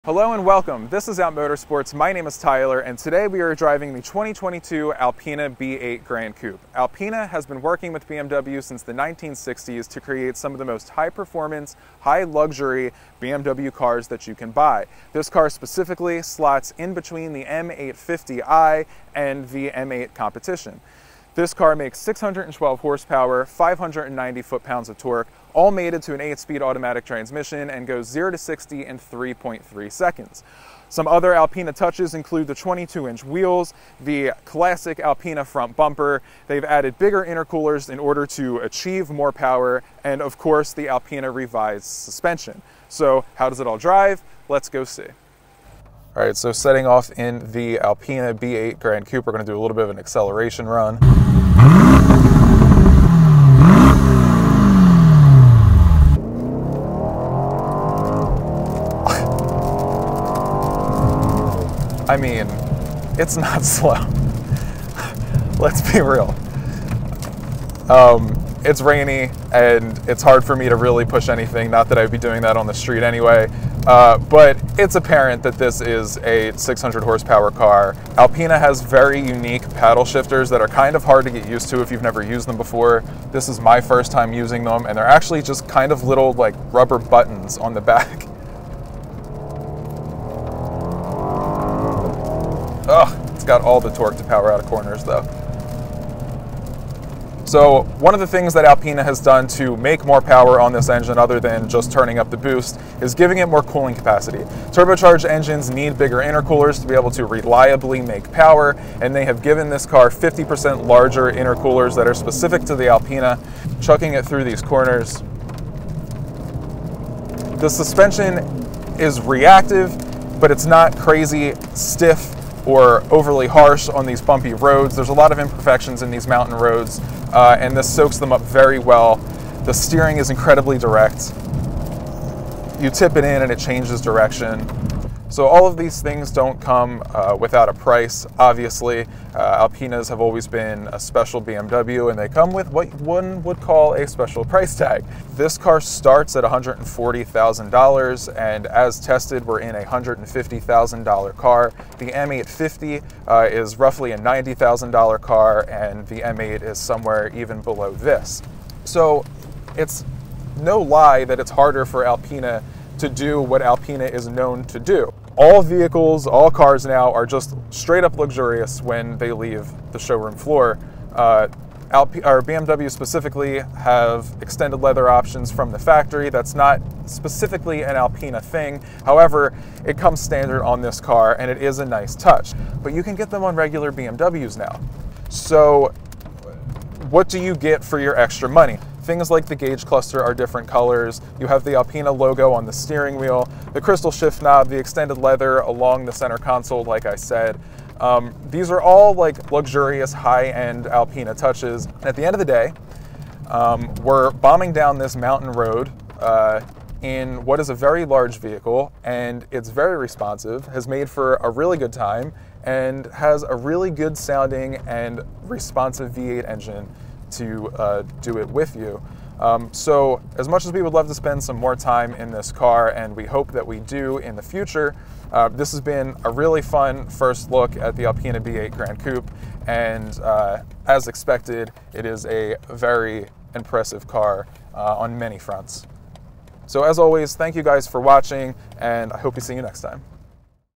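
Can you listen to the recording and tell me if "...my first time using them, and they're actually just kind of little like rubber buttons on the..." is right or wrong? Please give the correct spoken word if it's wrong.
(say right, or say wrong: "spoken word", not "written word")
right.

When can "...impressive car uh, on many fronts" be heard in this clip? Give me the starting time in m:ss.
3:53.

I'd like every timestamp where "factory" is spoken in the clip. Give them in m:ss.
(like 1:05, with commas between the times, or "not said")
2:55.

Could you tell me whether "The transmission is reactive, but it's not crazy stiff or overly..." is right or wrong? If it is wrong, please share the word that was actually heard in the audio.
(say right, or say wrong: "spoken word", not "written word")
wrong: "suspension", not "transmission".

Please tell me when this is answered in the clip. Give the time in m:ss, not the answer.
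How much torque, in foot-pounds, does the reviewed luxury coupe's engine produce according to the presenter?
0:23.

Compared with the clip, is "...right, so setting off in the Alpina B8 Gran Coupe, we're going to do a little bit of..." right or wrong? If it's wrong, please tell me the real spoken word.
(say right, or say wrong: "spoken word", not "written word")
right.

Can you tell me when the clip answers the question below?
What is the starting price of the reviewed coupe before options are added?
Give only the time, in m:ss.
2:26.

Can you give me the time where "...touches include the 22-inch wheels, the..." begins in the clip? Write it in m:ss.
0:31.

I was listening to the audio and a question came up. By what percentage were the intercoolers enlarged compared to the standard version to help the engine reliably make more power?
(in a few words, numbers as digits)
50%.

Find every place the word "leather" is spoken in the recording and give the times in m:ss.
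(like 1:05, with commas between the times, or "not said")
2:54, 3:15.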